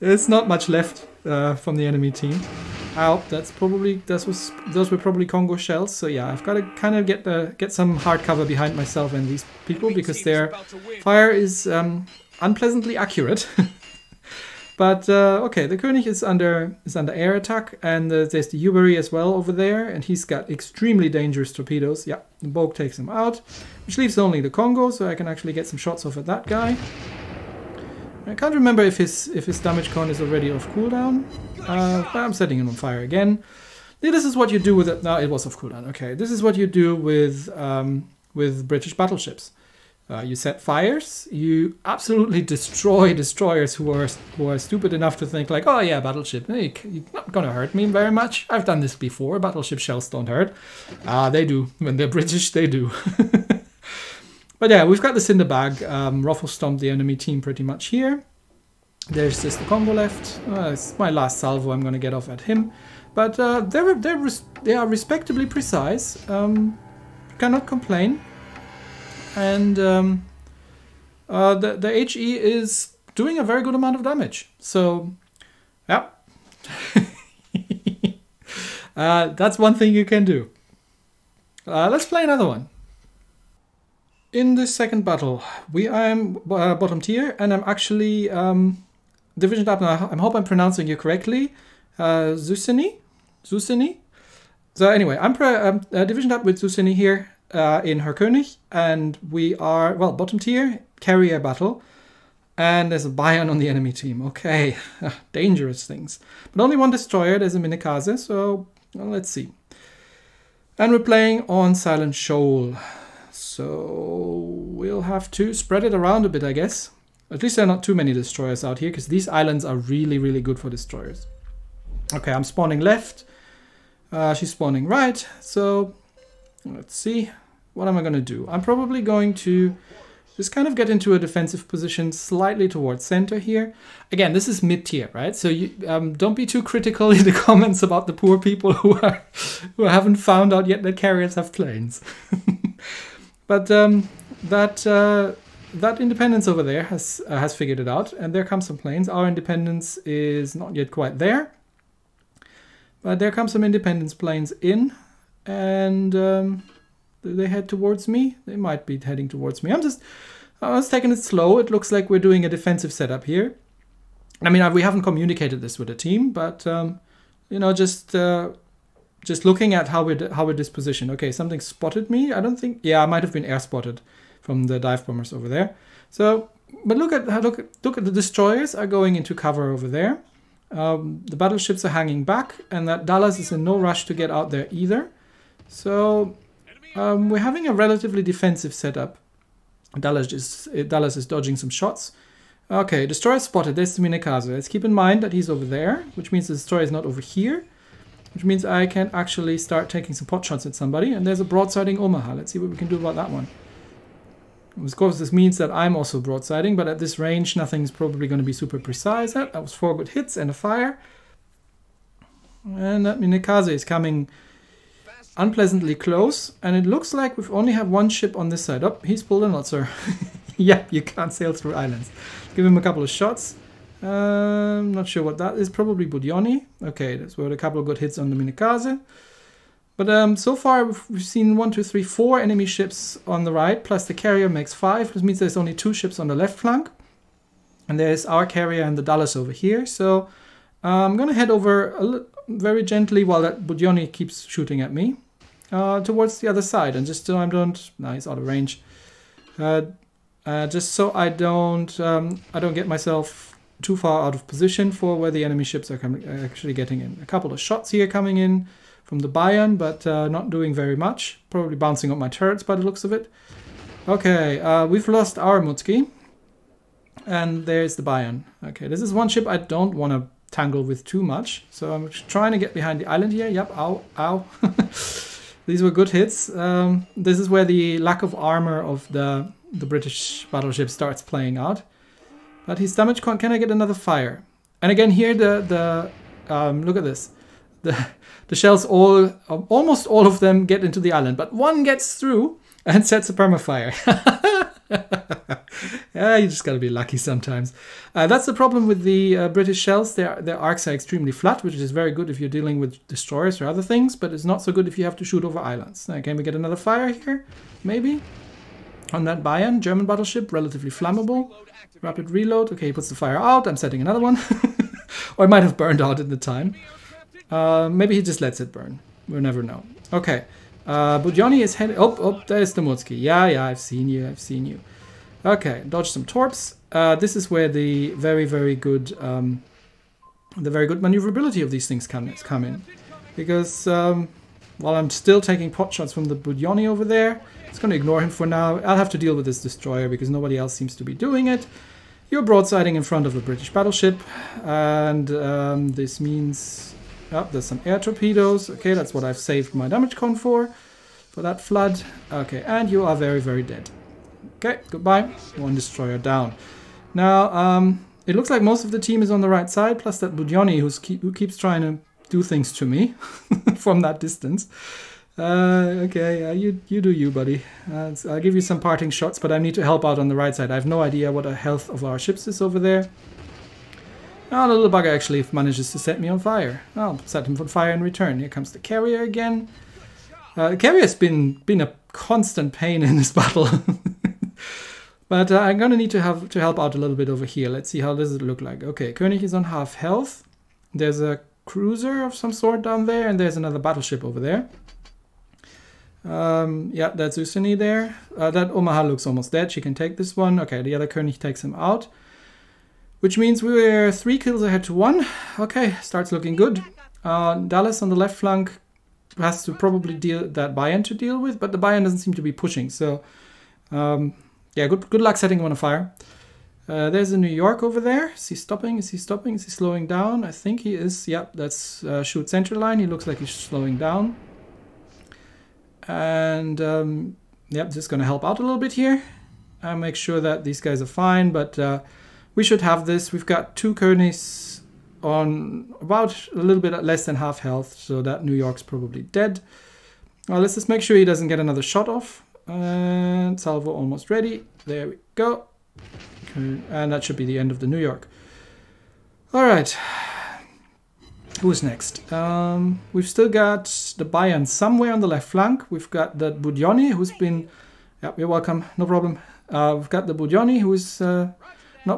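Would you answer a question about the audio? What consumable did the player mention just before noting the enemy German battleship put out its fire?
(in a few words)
Rapid reload.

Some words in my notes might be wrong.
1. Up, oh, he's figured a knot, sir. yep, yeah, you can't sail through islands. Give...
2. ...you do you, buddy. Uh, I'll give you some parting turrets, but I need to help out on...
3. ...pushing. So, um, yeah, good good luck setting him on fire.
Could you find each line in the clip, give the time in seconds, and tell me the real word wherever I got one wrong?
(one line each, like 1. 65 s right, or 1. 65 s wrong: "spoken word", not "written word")
1. 218 s wrong: "pulled", not "figured"
2. 366 s wrong: "shots", not "turrets"
3. 412 s right.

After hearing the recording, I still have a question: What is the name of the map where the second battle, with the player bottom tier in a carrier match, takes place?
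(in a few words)
Silent Shoal.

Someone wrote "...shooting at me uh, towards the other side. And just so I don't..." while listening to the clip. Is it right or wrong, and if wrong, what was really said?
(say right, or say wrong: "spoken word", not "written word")
right.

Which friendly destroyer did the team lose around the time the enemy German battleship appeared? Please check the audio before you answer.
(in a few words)
Mutsuki.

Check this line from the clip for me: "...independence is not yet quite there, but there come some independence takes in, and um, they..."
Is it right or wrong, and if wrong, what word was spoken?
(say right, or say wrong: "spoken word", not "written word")
wrong: "planes", not "takes".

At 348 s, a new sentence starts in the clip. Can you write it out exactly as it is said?
Okay, that's what I've saved my damage con for, for that flood.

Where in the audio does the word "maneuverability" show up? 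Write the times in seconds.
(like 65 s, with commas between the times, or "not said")
331 s.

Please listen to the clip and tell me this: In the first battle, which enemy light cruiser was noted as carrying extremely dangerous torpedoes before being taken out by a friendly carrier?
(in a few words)
Yubari.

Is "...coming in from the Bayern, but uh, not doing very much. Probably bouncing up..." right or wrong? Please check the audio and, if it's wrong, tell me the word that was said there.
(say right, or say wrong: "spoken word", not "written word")
right.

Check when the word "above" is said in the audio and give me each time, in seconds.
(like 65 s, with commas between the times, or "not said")
not said.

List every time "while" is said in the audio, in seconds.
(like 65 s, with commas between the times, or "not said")
243 s, 334 s.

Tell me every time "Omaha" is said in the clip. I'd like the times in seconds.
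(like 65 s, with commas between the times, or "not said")
201 s, 398 s.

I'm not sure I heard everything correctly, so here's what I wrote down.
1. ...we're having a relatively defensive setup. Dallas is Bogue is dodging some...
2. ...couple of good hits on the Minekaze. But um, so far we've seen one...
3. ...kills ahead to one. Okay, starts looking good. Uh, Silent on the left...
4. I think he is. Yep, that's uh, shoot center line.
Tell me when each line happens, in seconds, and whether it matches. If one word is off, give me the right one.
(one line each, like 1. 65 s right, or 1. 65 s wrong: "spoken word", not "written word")
1. 187 s wrong: "Dallas", not "Bogue"
2. 227 s right
3. 404 s wrong: "Dallas", not "Silent"
4. 420 s right.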